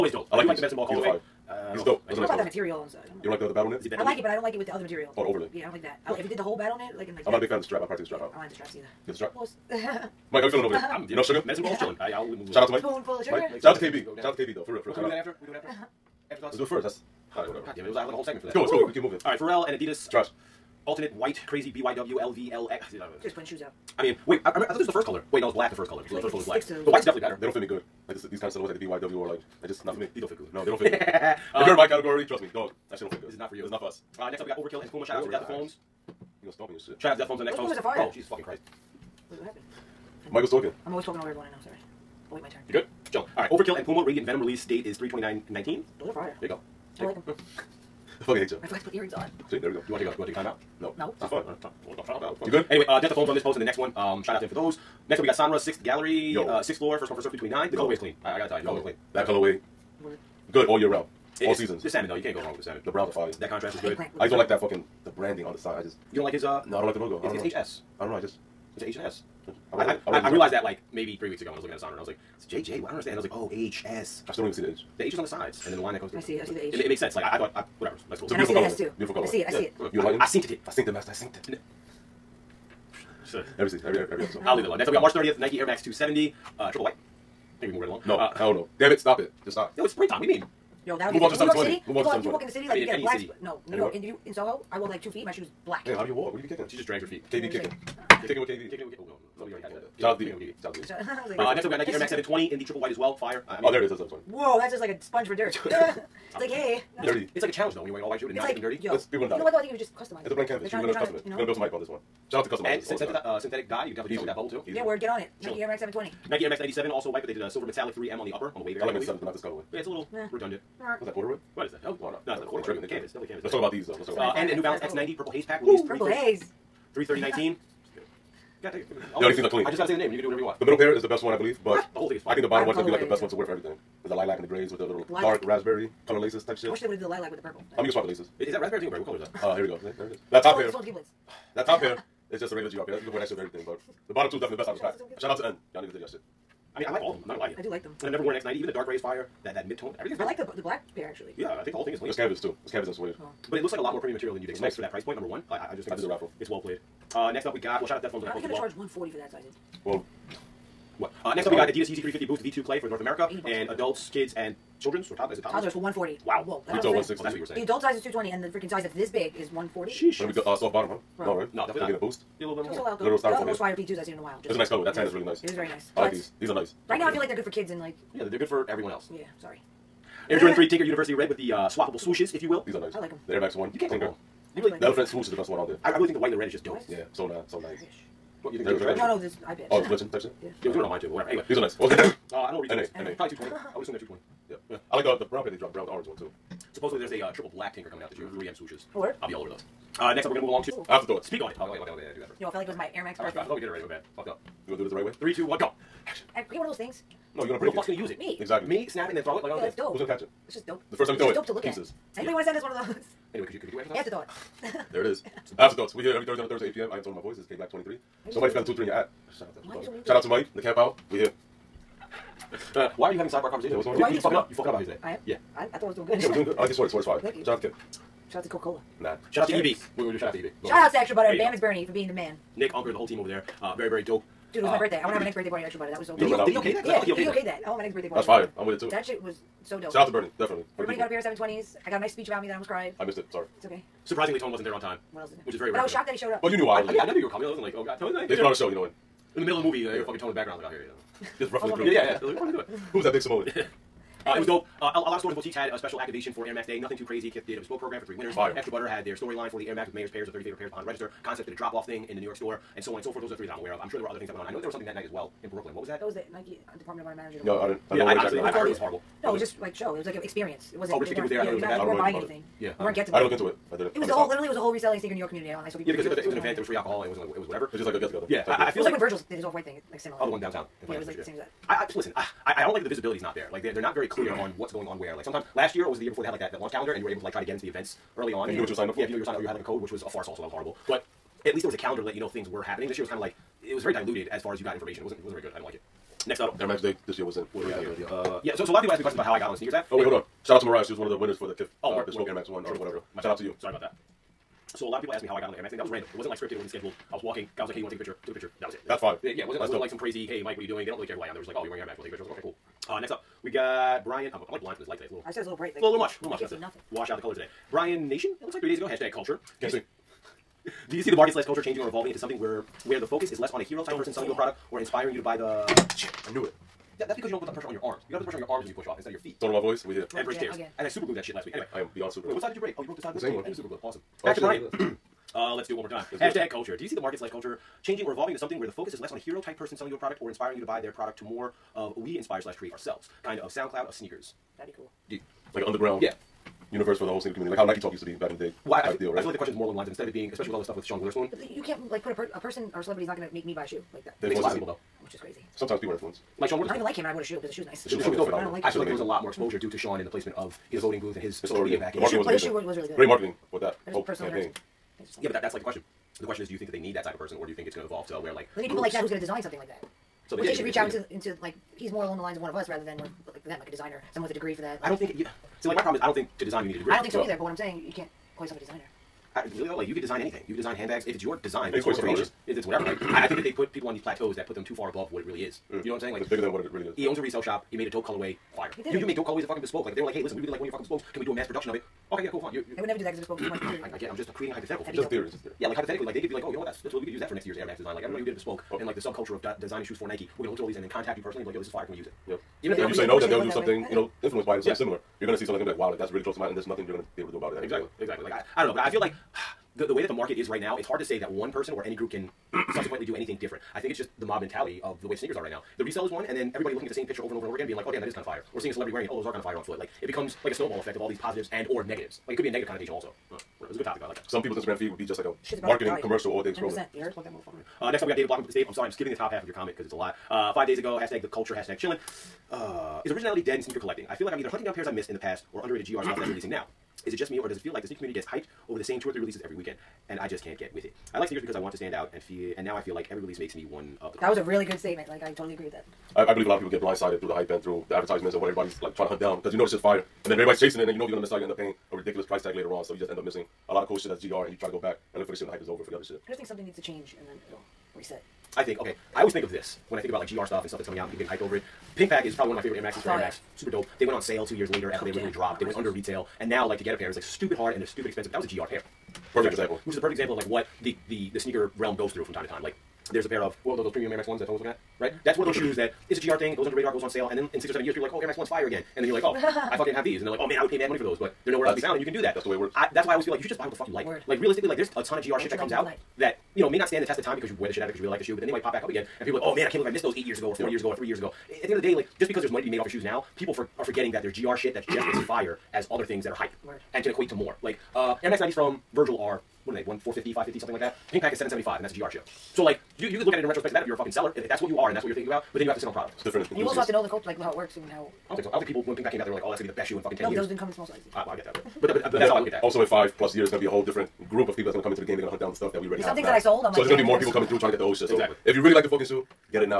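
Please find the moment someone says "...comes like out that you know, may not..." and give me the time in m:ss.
8:05.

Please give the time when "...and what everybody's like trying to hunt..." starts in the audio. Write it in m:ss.
7:28.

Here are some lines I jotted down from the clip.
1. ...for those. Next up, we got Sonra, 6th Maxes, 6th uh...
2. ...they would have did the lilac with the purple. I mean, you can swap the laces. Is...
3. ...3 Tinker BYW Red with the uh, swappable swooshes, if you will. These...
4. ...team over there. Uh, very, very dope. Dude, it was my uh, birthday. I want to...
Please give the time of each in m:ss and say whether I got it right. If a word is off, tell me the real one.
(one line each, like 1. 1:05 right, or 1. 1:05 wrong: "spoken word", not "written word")
1. 0:54 wrong: "Gallery", not "Maxes"
2. 2:16 right
3. 3:00 wrong: "University", not "BYW"
4. 3:53 right.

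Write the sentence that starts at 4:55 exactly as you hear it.
It wasn't it wasn't very good.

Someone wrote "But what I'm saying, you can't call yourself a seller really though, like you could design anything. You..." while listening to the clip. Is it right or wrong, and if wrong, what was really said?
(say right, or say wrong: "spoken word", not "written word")
wrong: "designer", not "seller".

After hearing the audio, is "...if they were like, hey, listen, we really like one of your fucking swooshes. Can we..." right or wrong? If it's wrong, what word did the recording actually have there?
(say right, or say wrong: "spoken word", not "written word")
wrong: "bespokes", not "swooshes".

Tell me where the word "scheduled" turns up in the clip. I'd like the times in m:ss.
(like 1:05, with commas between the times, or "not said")
5:06.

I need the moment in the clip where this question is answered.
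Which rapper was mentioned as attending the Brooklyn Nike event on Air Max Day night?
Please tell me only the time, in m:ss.
4:30.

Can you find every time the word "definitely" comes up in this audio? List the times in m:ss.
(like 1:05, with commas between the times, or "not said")
0:27, 1:53, 2:03, 2:24, 2:51, 4:00.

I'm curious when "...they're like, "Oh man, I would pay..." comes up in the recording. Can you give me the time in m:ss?
8:00.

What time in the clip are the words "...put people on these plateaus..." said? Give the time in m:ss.
6:23.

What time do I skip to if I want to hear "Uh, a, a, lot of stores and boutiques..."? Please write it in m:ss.
4:14.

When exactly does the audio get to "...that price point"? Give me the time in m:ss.
2:34.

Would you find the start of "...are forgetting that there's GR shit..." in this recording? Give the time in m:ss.
8:13.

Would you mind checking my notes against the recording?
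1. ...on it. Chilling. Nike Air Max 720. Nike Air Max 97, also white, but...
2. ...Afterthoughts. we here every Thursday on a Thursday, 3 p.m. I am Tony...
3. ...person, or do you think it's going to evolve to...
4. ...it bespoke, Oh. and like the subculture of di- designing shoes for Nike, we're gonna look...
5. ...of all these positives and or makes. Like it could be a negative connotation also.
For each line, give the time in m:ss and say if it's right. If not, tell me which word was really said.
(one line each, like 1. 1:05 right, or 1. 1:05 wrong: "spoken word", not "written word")
1. 1:55 right
2. 3:35 wrong: "8", not "3"
3. 6:07 right
4. 6:38 right
5. 7:00 wrong: "negatives", not "makes".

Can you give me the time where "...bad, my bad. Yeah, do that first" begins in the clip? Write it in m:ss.
3:21.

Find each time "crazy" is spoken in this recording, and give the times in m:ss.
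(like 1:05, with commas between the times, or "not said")
0:21, 4:17, 5:09, 5:55.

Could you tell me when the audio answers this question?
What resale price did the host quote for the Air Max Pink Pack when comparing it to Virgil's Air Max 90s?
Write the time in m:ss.
8:21.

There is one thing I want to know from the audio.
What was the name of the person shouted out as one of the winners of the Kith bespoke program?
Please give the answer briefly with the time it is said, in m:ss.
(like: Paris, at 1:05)
Mariah, at 5:00.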